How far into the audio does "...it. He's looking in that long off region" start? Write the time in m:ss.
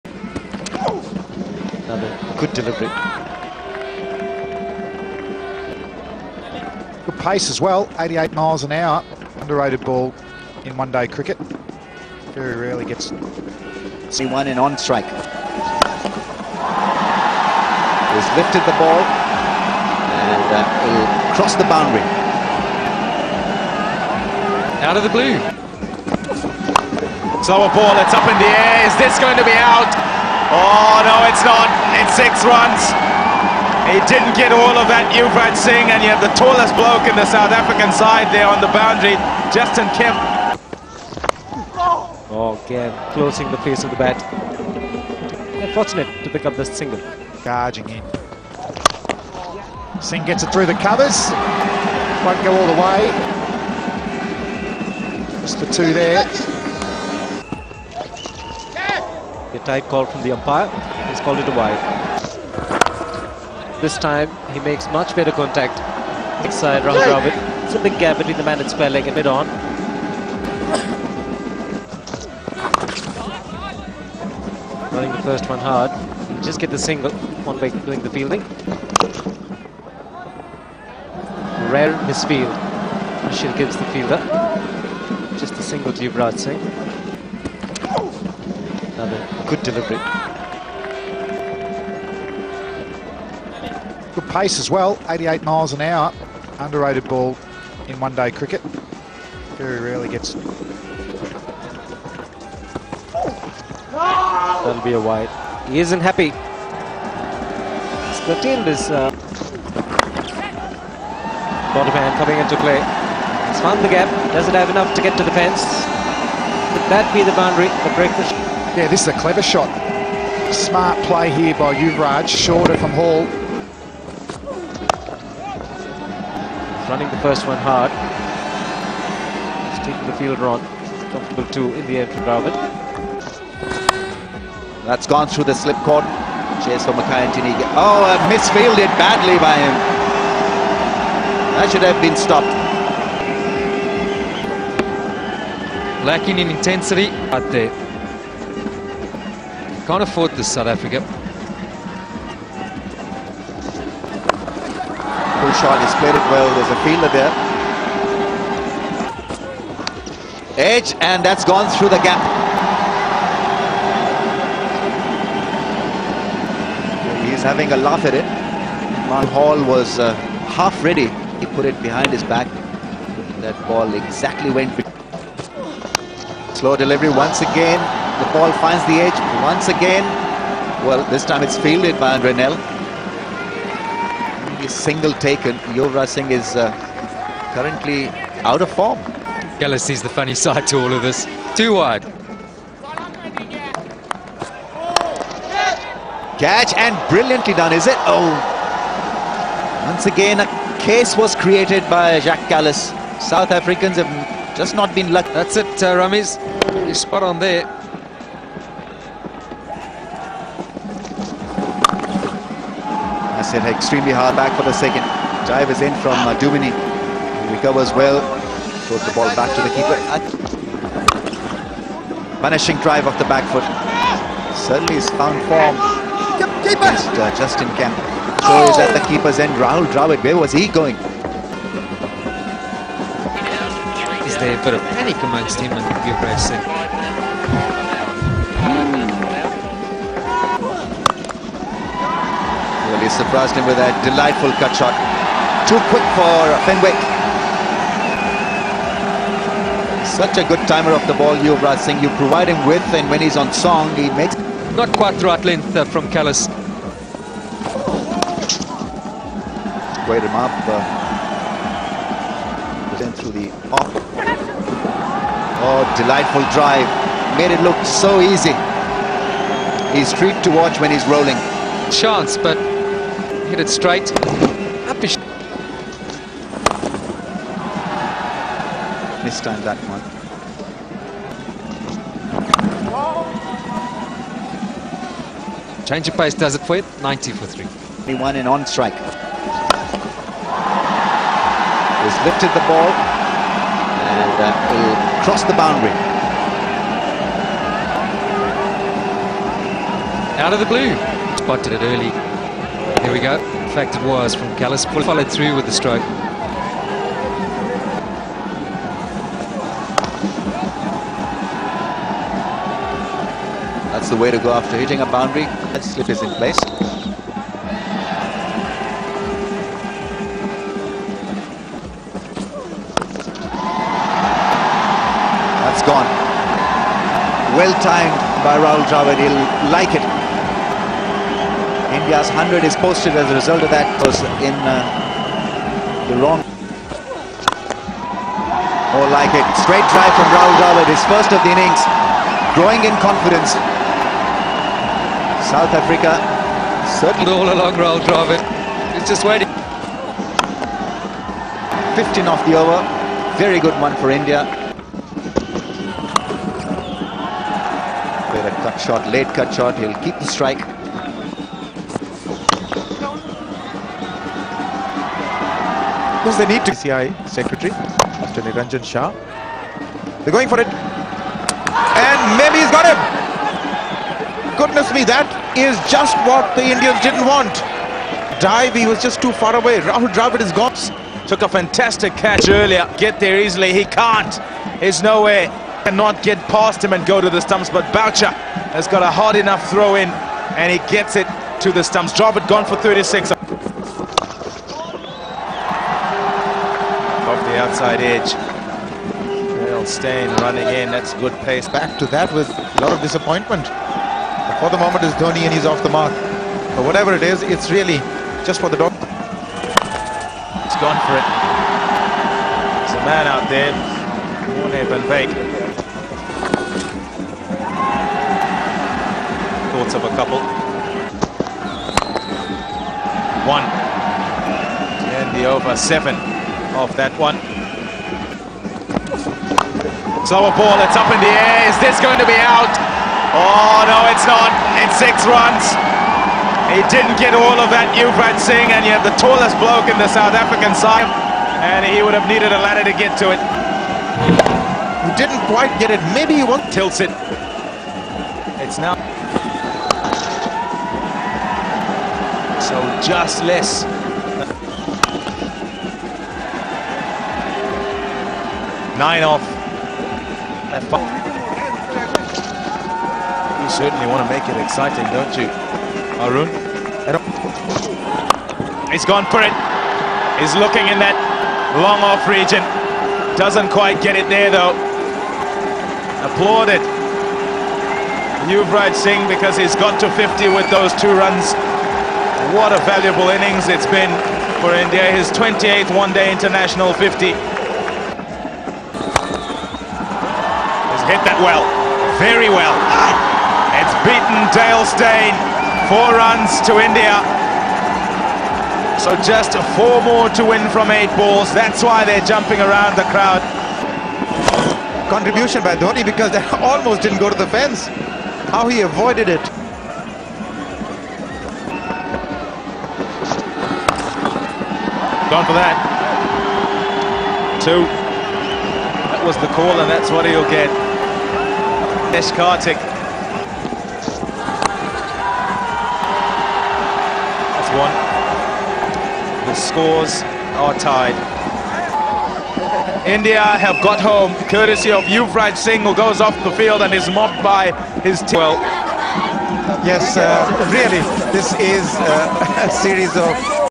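7:49.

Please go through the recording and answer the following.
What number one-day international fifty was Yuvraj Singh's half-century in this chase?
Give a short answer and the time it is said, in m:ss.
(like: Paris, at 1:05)
28th, at 8:05.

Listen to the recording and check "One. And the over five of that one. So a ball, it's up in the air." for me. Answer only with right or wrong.
wrong.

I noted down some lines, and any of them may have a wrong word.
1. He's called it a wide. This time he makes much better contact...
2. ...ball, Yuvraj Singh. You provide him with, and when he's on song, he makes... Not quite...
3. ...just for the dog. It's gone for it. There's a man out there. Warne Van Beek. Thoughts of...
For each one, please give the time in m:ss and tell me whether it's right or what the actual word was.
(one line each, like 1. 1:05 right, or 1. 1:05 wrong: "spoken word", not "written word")
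1. 1:01 right
2. 4:11 right
3. 6:48 right.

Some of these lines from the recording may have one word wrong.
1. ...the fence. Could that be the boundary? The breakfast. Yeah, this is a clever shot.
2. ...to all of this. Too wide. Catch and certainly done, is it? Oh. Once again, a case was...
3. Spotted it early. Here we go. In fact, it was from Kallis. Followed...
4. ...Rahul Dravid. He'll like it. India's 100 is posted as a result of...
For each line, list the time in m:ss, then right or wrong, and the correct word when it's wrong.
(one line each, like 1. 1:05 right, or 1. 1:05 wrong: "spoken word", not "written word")
1. 1:55 right
2. 3:10 wrong: "brilliantly", not "certainly"
3. 5:01 right
4. 5:28 right.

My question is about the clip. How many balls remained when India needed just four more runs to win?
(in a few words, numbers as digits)
8.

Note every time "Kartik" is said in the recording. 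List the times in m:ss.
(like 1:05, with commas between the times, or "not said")
8:42.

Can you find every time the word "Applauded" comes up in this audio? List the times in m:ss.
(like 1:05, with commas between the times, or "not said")
7:56.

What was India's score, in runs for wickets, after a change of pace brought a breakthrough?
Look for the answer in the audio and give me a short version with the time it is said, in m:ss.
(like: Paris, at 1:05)
90 for 3, at 4:47.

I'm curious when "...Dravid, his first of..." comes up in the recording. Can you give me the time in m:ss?
5:40.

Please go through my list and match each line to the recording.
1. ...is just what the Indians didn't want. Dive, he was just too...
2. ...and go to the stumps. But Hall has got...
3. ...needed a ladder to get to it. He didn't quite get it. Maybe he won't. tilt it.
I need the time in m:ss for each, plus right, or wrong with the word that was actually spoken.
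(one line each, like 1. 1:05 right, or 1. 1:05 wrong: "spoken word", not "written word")
1. 6:15 right
2. 6:26 wrong: "Boucher", not "Hall"
3. 7:22 right.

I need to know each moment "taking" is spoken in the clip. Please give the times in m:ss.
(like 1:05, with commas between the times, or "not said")
2:09.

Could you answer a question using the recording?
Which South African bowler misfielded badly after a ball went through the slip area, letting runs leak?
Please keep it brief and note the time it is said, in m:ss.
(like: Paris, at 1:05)
Makhaya Ntini, at 2:16.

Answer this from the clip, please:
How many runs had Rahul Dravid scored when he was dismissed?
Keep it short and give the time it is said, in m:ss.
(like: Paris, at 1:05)
36, at 6:32.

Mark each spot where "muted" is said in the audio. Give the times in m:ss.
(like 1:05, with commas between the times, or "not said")
not said.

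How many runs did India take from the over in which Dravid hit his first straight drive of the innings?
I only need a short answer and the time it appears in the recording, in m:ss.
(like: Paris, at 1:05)
15, at 5:51.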